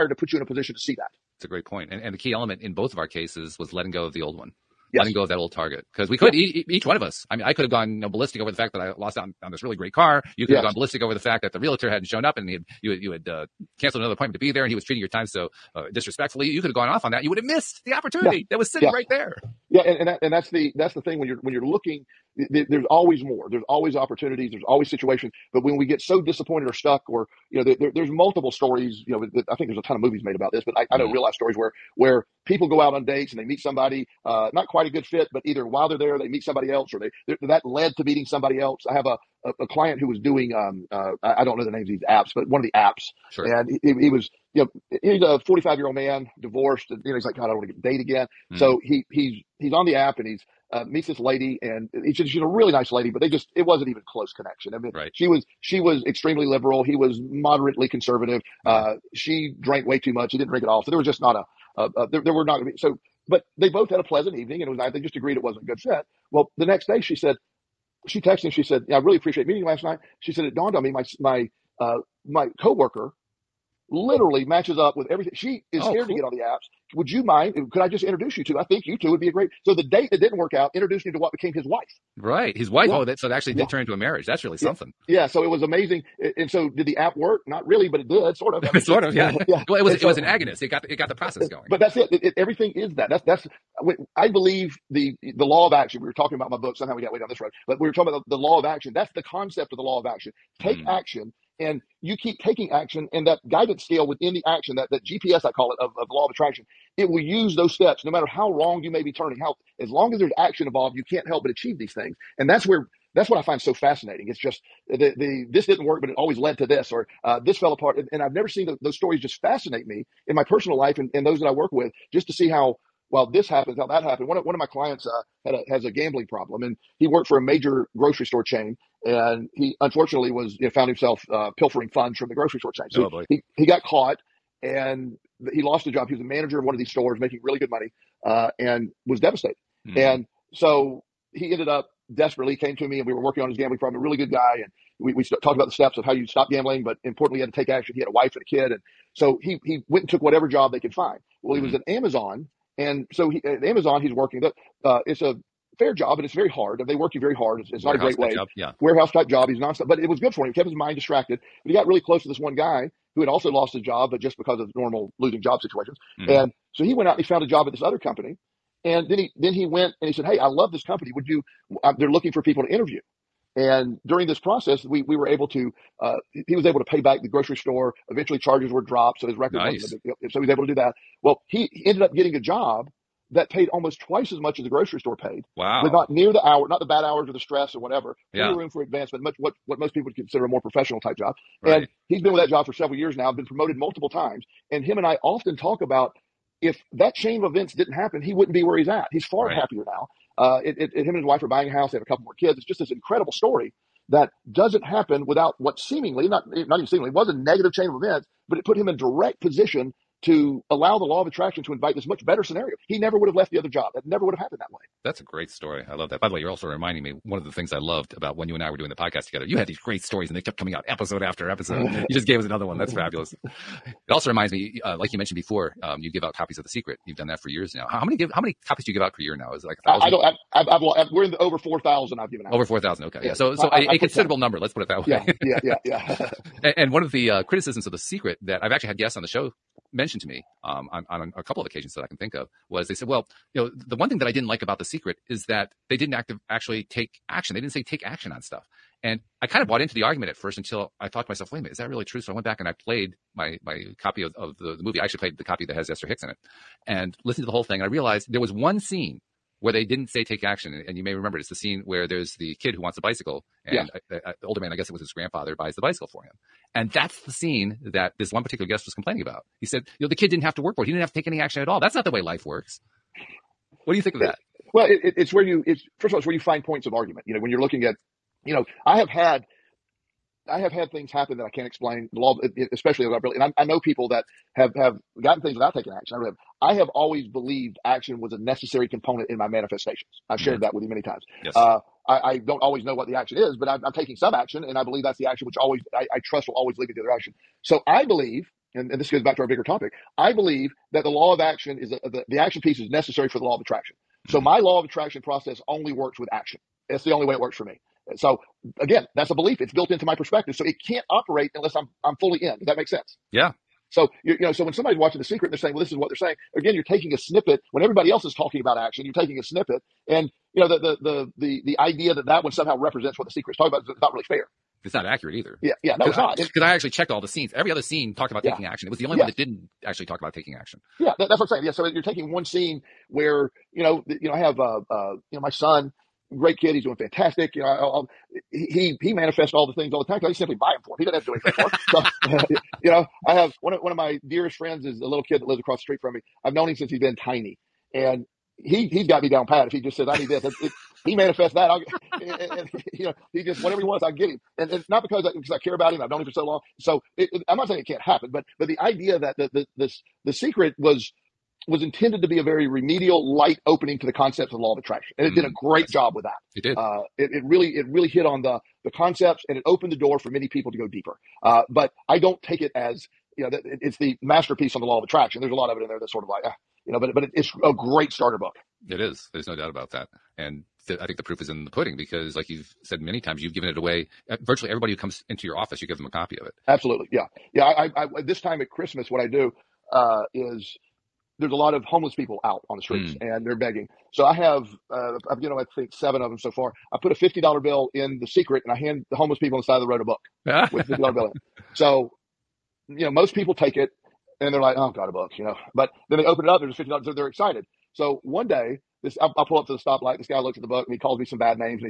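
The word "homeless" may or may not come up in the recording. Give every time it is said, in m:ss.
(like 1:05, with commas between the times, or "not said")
6:31, 6:39.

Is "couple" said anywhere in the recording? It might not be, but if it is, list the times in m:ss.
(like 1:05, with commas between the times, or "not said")
3:22, 4:01.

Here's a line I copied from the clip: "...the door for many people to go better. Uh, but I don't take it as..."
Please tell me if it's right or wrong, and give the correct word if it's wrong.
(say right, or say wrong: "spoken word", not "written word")
wrong: "deeper", not "better".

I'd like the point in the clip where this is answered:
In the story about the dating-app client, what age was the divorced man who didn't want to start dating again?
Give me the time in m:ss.
0:45.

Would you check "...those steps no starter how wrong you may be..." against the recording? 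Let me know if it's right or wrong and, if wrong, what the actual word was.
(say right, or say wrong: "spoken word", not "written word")
wrong: "matter", not "starter".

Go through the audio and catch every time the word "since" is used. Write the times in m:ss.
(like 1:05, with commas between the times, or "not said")
5:46.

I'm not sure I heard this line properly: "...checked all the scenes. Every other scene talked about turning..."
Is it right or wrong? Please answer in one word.
wrong.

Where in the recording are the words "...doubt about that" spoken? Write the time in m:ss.
6:19.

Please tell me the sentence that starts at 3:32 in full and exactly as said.
He never would have left the other job.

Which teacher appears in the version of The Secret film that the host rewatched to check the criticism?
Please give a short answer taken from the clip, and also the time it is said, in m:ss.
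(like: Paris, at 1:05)
Esther Hicks, at 4:15.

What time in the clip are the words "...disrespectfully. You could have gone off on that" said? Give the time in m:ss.
0:15.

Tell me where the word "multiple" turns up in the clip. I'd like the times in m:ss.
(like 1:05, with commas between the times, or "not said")
0:28, 3:13.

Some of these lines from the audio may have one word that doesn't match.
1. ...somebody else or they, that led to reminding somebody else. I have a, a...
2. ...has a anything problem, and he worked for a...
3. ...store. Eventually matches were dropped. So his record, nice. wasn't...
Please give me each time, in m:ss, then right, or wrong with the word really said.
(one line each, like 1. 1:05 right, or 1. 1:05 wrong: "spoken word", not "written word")
1. 0:36 wrong: "meeting", not "reminding"
2. 2:05 wrong: "gambling", not "anything"
3. 2:57 wrong: "charges", not "matches".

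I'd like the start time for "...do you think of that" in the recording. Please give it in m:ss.
4:33.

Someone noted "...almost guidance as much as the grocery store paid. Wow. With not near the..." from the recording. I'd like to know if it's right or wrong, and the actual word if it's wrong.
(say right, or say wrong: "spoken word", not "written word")
wrong: "twice", not "guidance".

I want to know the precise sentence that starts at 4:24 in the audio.
I, I, the older man, I guess it was his grandfather, buys the bicycle for him.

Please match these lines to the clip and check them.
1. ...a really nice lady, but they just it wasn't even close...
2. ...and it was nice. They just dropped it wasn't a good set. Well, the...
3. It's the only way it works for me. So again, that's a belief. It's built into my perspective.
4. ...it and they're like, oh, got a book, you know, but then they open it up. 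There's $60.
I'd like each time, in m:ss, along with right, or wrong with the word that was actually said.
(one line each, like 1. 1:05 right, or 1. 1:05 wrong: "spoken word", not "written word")
1. 0:52 right
2. 1:04 wrong: "agreed", not "dropped"
3. 5:06 right
4. 6:43 wrong: "50", not "60".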